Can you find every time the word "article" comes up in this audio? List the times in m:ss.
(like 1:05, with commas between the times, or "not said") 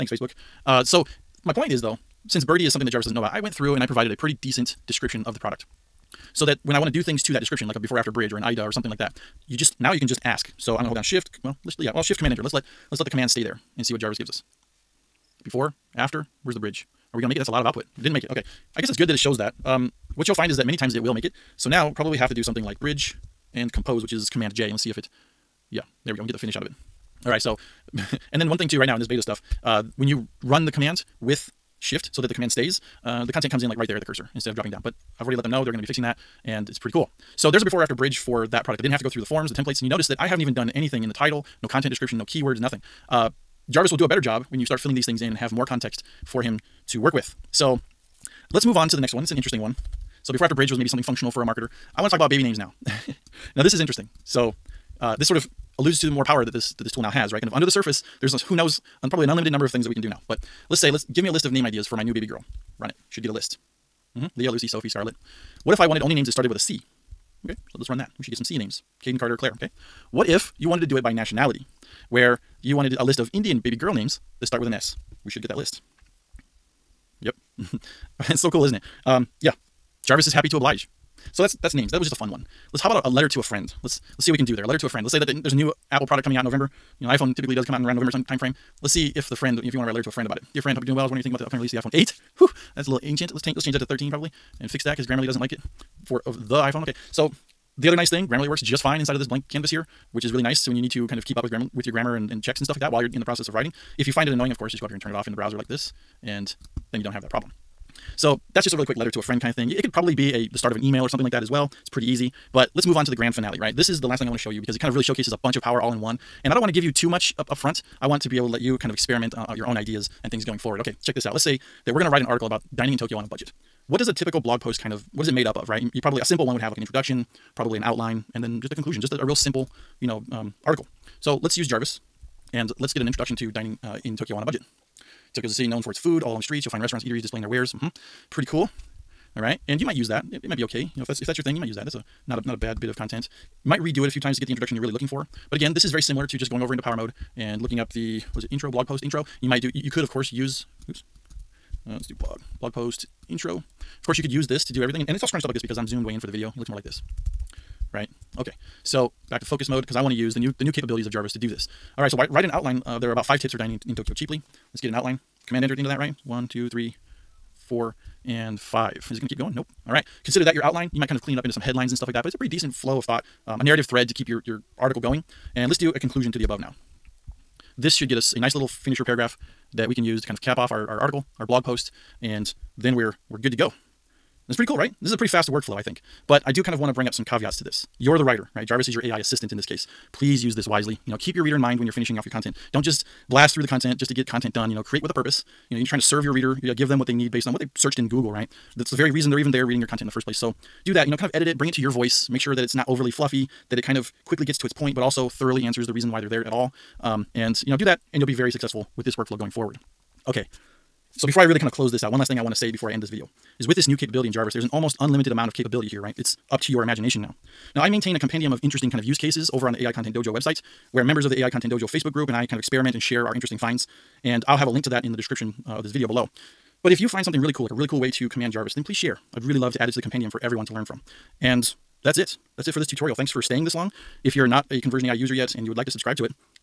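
2:02, 2:10, 2:54, 3:01.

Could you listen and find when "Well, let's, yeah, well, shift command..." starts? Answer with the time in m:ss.
0:11.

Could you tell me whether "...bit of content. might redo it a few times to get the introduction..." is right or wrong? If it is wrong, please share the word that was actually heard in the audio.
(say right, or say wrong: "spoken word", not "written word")
right.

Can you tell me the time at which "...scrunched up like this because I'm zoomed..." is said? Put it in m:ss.
2:35.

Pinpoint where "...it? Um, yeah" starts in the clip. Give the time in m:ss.
1:18.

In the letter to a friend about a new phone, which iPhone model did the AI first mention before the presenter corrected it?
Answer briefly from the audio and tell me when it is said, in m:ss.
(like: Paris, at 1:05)
iPhone 8, at 1:31.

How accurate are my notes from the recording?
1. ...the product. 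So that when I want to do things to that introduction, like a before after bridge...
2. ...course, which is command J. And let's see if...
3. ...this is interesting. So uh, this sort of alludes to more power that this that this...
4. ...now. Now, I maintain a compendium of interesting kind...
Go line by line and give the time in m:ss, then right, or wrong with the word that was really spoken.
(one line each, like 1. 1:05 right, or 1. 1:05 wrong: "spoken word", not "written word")
1. 0:05 wrong: "description", not "introduction"
2. 0:23 wrong: "compose", not "course"
3. 0:53 right
4. 3:37 right.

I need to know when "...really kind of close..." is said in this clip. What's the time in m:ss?
3:31.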